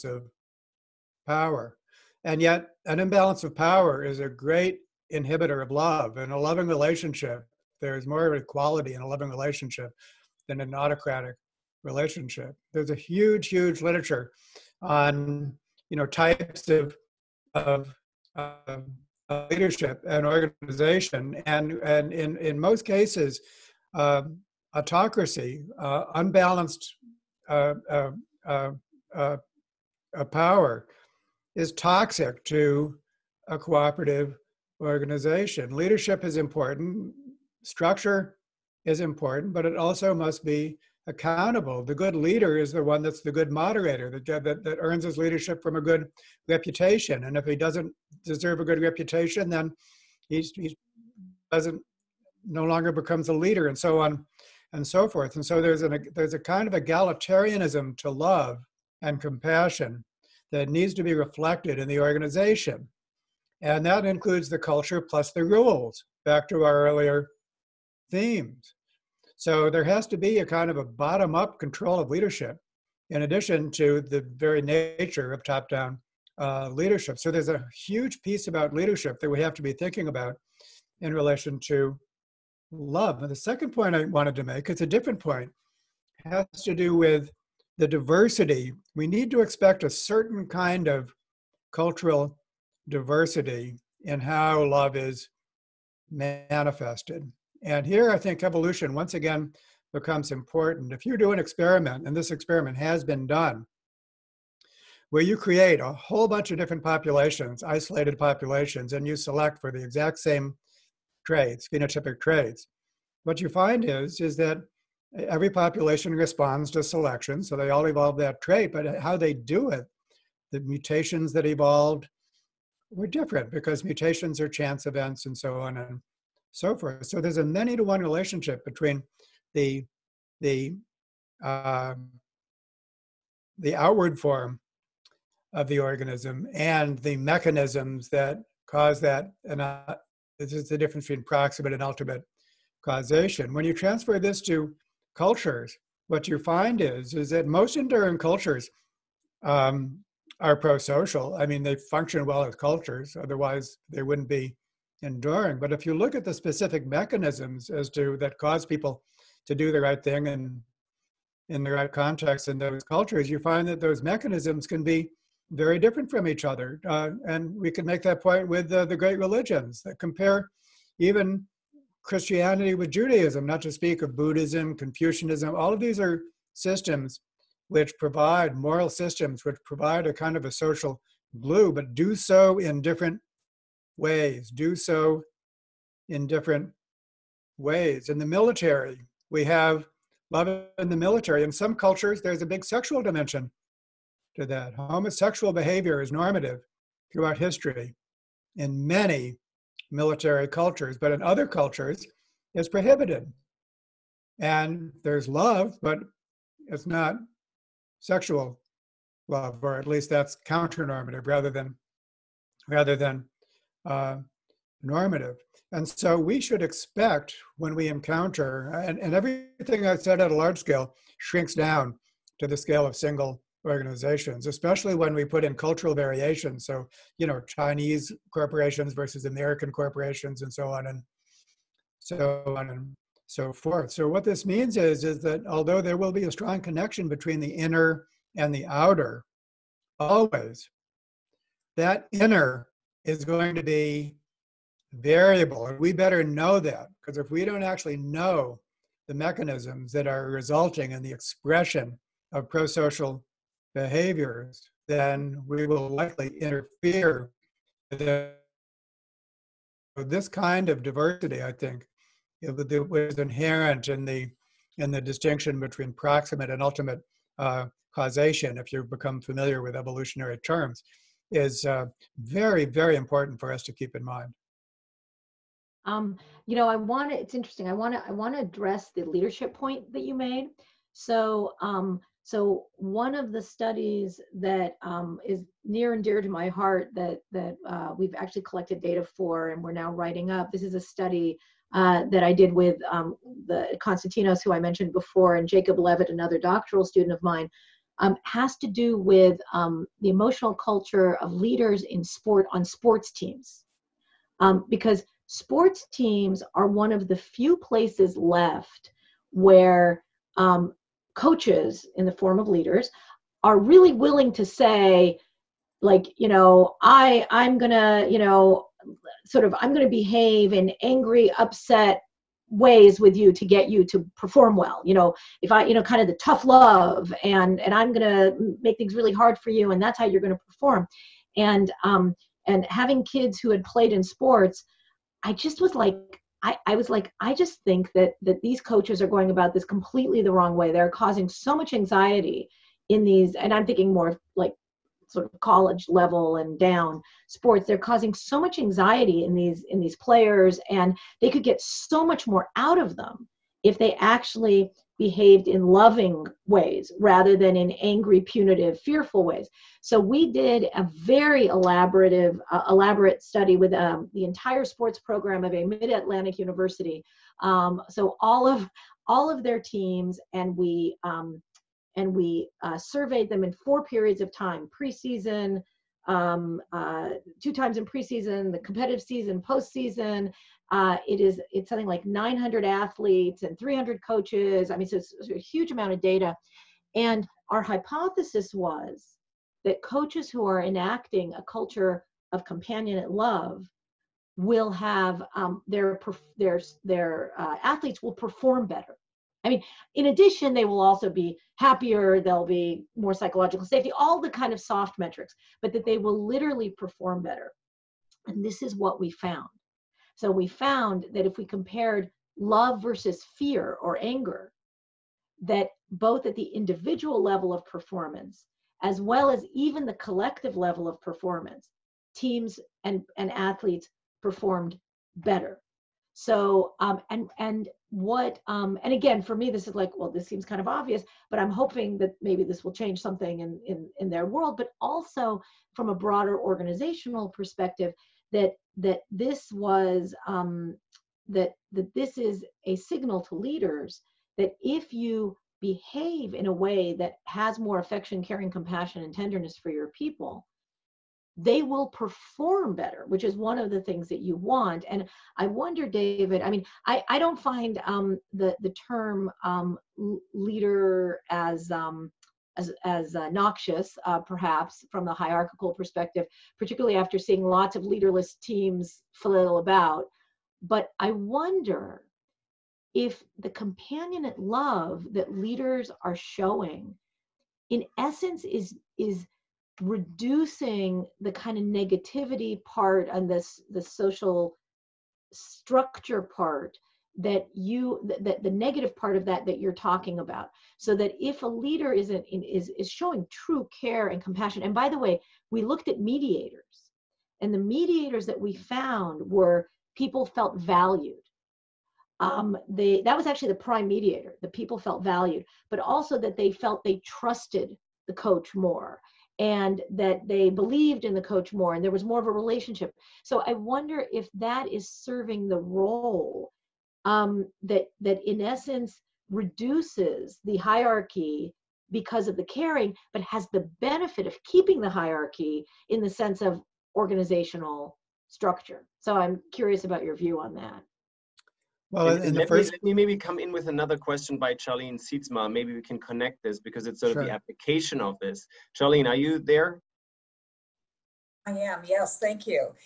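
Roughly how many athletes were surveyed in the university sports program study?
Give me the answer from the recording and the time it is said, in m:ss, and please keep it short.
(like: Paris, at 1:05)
900, at 6:22.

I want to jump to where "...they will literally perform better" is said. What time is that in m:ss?
6:45.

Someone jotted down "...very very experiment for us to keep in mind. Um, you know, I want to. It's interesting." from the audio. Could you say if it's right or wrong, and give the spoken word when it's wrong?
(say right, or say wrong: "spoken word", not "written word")
wrong: "important", not "experiment".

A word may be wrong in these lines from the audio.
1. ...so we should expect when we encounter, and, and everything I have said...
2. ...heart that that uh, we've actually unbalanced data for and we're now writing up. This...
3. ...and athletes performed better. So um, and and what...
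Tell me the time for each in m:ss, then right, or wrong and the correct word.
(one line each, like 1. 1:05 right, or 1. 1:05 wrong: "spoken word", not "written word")
1. 3:35 right
2. 4:46 wrong: "collected", not "unbalanced"
3. 7:03 right.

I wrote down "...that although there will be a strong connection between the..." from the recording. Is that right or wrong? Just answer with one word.
right.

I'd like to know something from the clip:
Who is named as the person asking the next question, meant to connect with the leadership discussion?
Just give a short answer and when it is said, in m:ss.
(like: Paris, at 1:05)
Charlene Sietzma, at 8:54.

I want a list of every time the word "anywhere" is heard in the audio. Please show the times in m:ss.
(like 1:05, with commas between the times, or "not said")
not said.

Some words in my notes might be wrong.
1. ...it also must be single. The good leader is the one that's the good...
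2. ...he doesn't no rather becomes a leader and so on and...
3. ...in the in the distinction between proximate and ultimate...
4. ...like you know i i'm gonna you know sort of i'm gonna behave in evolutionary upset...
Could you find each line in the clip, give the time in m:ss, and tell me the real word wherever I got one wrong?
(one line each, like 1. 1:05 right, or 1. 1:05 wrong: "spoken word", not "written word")
1. 0:39 wrong: "accountable", not "single"
2. 0:50 wrong: "longer", not "rather"
3. 4:23 right
4. 5:15 wrong: "angry", not "evolutionary".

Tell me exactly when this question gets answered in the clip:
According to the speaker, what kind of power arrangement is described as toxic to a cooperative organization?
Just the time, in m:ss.
0:24.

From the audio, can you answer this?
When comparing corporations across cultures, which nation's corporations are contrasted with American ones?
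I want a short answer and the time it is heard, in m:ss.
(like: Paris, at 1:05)
Chinese, at 3:47.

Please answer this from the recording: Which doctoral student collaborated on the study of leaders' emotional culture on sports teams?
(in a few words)
Jacob Levitt.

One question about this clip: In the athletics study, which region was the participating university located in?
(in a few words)
Mid-Atlantic.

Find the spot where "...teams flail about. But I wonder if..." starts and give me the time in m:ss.
7:48.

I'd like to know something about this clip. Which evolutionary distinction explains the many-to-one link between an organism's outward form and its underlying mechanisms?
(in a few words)
Proximate and ultimate causation.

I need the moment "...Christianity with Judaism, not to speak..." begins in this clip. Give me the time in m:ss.
2:52.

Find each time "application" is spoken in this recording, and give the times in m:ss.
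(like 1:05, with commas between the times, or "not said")
8:57.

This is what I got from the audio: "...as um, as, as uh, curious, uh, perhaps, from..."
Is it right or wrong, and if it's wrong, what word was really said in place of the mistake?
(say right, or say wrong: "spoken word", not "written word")
wrong: "noxious", not "curious".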